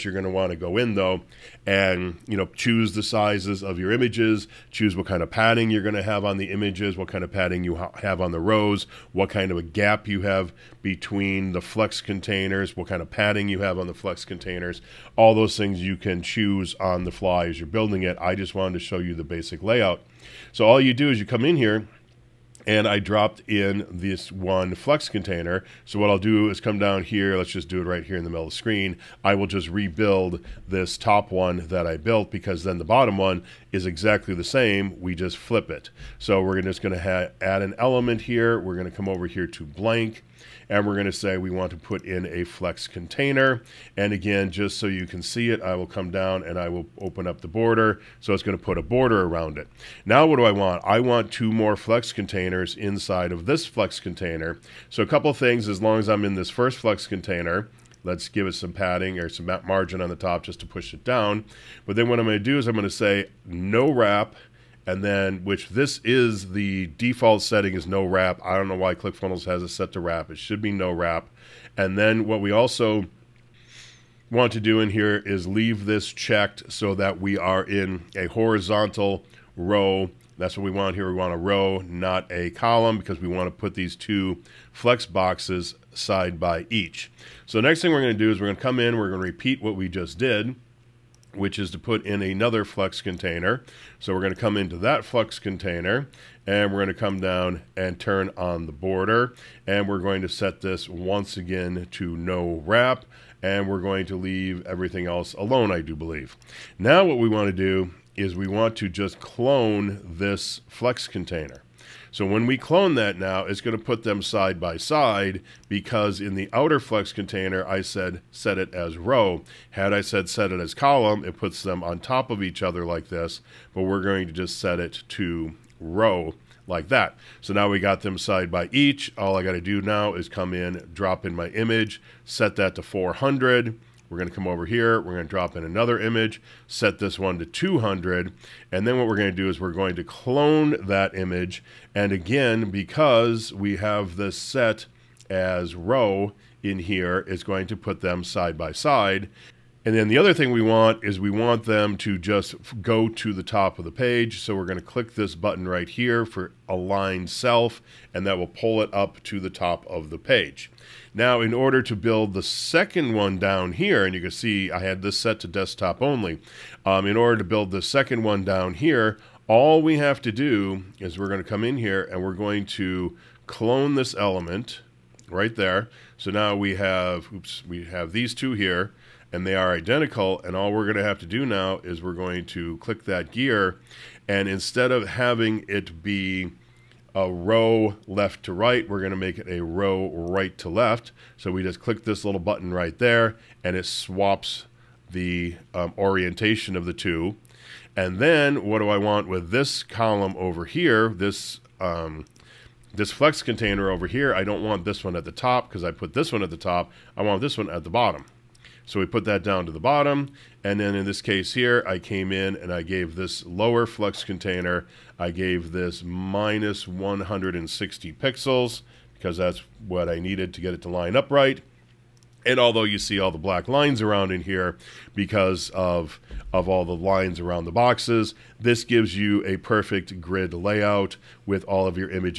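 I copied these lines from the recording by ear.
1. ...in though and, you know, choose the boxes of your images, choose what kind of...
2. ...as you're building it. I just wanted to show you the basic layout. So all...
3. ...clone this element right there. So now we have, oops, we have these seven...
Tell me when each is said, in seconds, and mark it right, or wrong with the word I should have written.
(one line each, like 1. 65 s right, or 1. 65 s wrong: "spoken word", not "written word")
1. 0 s wrong: "sizes", not "boxes"
2. 17 s right
3. 173 s wrong: "two", not "seven".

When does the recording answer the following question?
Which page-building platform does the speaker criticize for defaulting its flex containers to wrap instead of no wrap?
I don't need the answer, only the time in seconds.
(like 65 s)
68 s.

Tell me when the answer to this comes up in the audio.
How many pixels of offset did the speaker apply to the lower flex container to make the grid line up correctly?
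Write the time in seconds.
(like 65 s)
216 s.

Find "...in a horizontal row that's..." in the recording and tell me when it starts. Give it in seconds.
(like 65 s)
77 s.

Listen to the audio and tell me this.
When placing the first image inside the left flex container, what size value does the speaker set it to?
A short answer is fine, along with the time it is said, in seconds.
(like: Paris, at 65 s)
400, at 132 s.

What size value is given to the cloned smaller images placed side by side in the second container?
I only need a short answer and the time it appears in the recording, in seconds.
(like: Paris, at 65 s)
200, at 137 s.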